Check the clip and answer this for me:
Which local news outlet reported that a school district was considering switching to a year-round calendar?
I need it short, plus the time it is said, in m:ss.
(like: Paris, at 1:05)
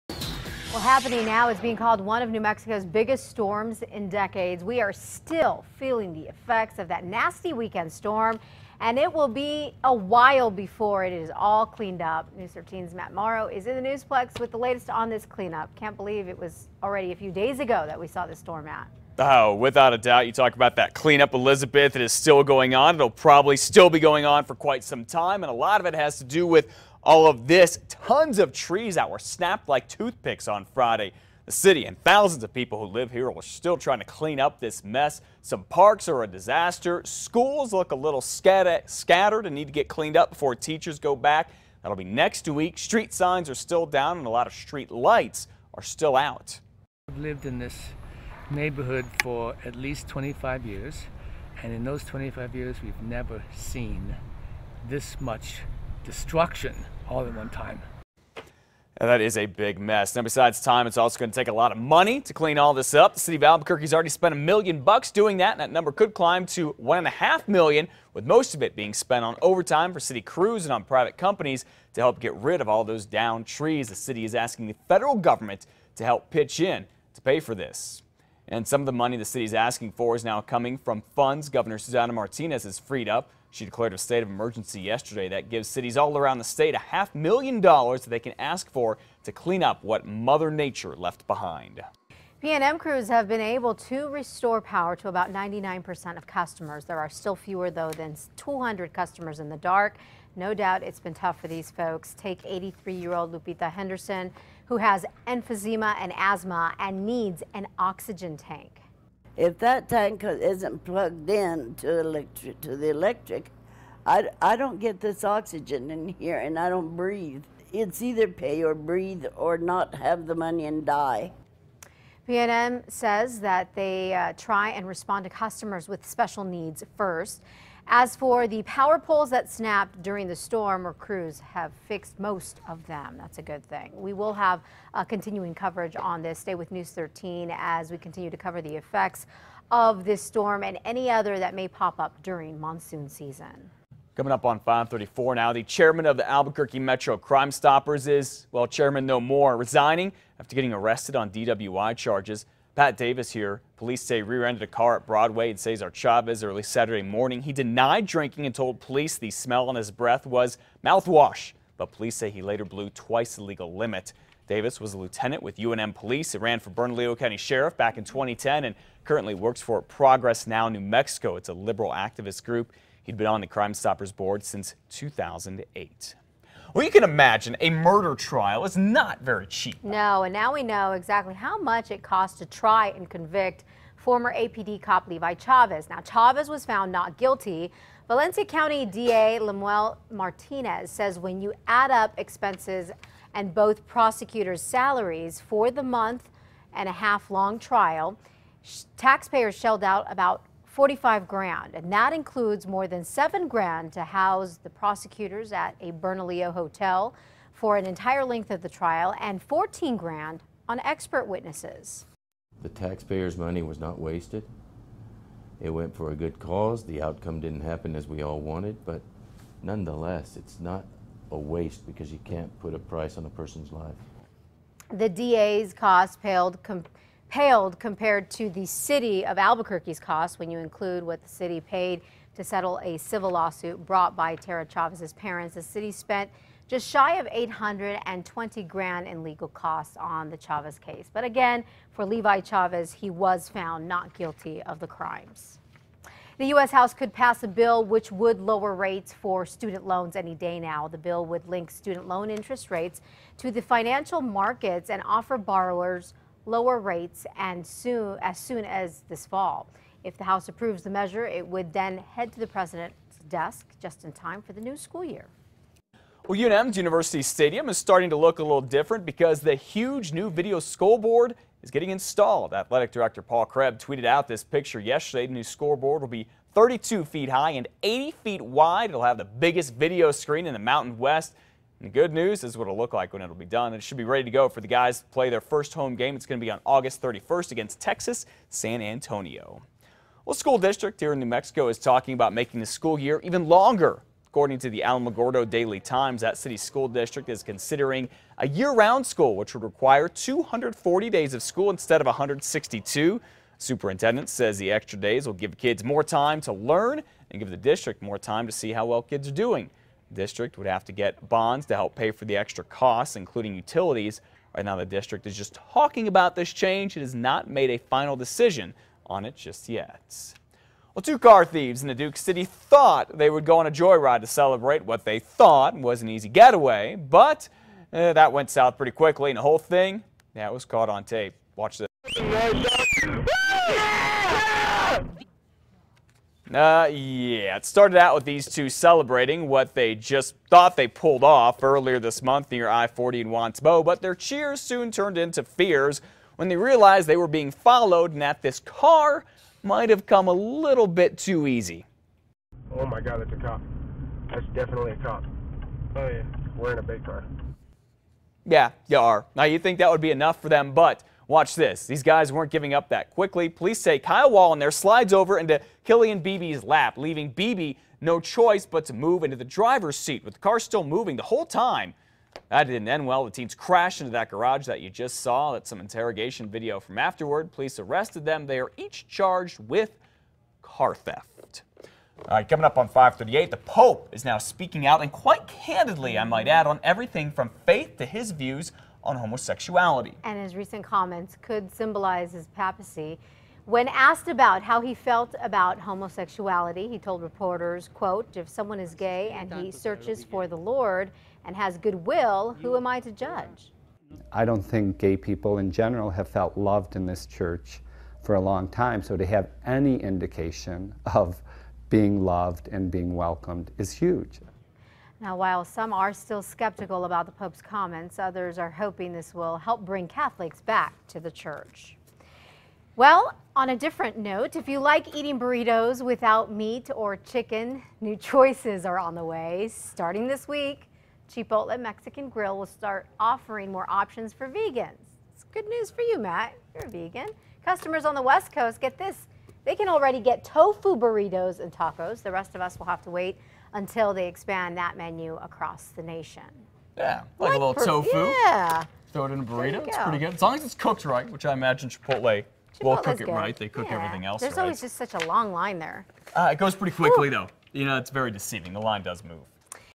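Alamogordo Daily Times, at 4:54.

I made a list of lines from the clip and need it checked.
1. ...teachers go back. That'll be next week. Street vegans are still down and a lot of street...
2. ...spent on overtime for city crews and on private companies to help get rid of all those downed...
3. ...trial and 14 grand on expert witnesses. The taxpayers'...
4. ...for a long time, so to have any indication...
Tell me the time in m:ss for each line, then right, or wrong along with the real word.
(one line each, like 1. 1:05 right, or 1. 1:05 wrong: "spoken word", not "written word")
1. 0:40 wrong: "signs", not "vegans"
2. 1:08 right
3. 3:28 right
4. 6:48 right.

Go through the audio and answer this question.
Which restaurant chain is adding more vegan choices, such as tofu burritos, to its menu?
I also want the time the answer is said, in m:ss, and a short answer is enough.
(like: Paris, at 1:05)
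Chipotle Mexican Grill, at 7:11.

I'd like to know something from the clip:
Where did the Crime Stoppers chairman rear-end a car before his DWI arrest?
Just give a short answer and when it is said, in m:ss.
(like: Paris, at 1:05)
Broadway and Cesar Chavez, at 2:35.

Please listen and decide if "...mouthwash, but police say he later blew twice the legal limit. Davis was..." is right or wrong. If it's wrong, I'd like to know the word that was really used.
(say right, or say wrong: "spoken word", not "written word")
right.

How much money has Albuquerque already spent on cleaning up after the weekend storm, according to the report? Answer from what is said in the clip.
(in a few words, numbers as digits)
$1 million.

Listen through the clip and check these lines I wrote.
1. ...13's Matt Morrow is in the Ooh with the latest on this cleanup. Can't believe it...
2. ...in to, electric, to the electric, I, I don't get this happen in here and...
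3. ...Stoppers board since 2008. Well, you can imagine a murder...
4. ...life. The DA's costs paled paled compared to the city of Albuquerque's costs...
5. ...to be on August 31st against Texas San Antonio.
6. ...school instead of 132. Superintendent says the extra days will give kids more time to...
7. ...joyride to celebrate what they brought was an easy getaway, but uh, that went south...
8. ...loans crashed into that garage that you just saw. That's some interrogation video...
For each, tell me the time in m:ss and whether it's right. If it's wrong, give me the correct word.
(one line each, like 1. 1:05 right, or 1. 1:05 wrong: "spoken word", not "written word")
1. 0:12 wrong: "Newsplex", not "Ooh"
2. 1:51 wrong: "oxygen", not "happen"
3. 2:53 right
4. 3:43 right
5. 4:46 right
6. 5:01 wrong: "162", not "132"
7. 5:23 wrong: "thought", not "brought"
8. 6:13 wrong: "teens", not "loans".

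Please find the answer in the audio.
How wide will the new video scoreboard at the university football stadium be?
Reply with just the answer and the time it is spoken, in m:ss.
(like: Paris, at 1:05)
80 feet, at 4:37.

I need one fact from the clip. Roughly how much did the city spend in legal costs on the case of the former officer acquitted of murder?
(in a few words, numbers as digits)
$820,000.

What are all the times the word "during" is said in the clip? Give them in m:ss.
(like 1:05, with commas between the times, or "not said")
2:10, 2:22.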